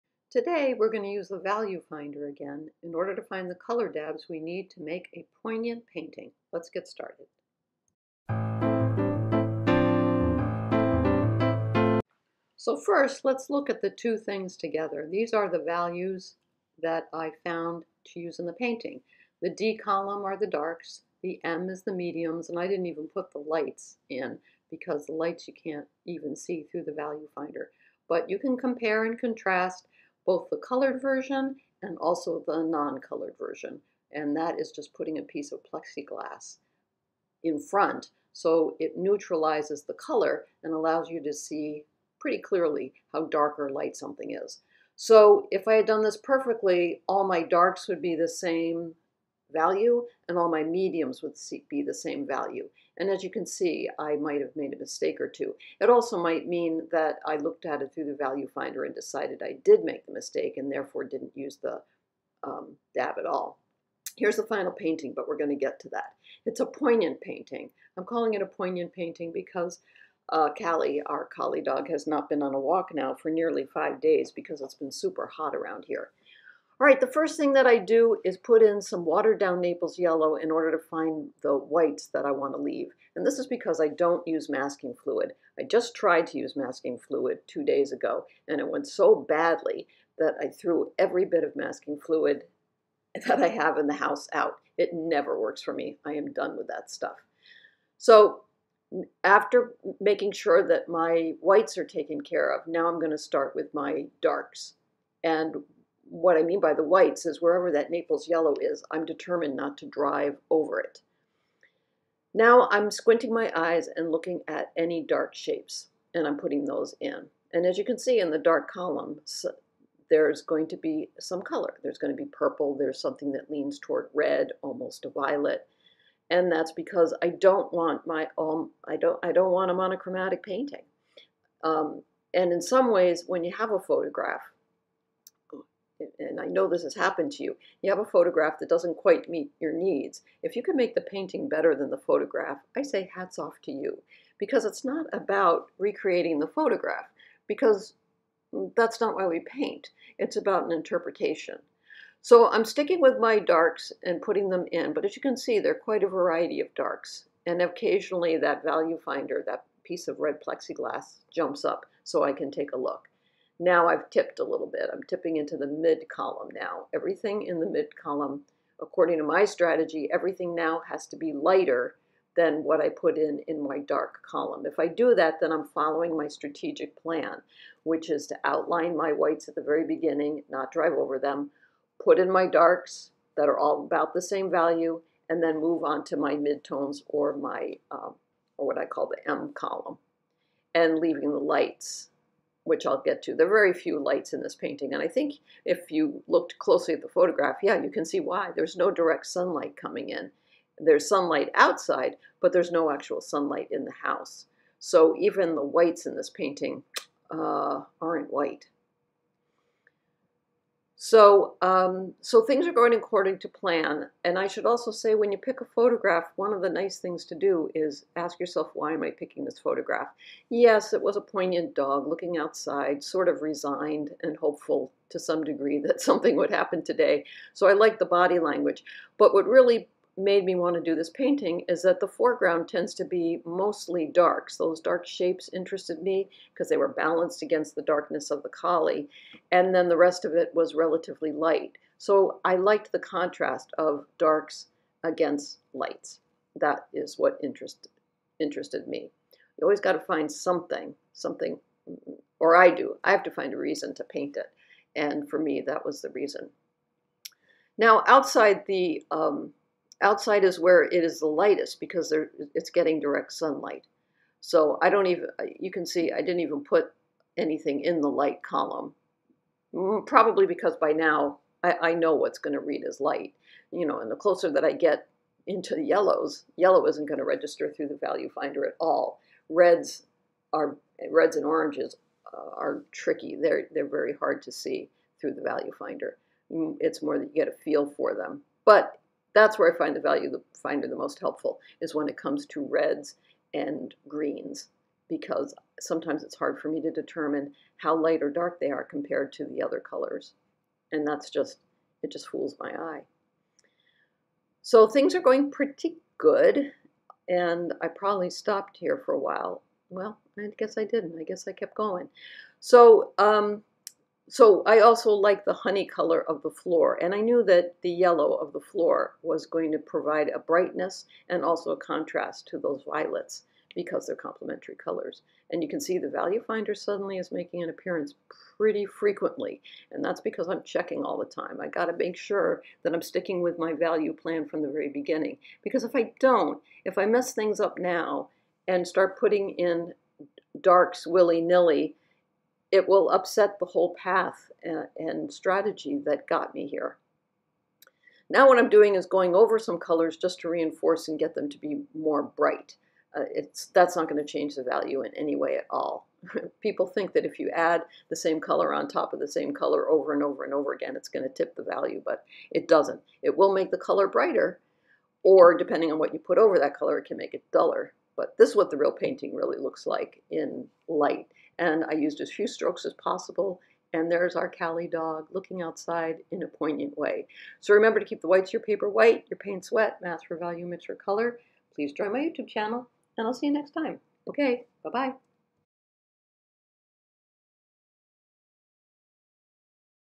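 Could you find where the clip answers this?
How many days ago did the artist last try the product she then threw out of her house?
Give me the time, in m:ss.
1:27.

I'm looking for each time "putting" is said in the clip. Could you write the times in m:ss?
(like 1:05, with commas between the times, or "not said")
0:34, 1:56, 2:34, 5:39.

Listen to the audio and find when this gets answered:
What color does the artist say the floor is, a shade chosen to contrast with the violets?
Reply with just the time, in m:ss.
5:15.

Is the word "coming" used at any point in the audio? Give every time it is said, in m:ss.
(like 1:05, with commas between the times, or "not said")
3:19.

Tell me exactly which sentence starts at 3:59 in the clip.
And then the rest of it was relatively light.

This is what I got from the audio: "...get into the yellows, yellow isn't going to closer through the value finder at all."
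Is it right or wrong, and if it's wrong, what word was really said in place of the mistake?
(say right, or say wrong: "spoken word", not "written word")
wrong: "register", not "closer".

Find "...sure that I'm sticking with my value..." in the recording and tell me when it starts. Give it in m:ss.
5:32.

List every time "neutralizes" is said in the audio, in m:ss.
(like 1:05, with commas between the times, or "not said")
0:38.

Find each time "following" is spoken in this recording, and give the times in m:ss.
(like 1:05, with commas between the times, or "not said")
2:55.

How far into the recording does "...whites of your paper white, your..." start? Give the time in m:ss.
6:18.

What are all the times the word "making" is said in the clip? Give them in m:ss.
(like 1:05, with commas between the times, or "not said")
1:39, 5:27.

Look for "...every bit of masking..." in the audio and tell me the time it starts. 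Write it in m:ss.
1:30.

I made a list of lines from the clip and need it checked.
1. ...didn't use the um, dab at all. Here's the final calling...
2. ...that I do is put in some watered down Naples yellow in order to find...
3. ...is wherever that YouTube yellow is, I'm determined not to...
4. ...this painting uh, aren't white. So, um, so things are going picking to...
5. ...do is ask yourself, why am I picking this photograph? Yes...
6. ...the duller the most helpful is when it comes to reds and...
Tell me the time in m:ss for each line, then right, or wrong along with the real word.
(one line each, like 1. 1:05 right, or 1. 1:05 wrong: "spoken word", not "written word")
1. 1:01 wrong: "painting", not "calling"
2. 1:17 right
3. 1:47 wrong: "Naples", not "YouTube"
4. 3:26 wrong: "according", not "picking"
5. 3:37 right
6. 4:50 wrong: "finder", not "duller".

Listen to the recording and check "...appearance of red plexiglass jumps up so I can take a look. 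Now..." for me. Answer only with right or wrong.
wrong.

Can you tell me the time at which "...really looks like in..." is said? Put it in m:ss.
6:09.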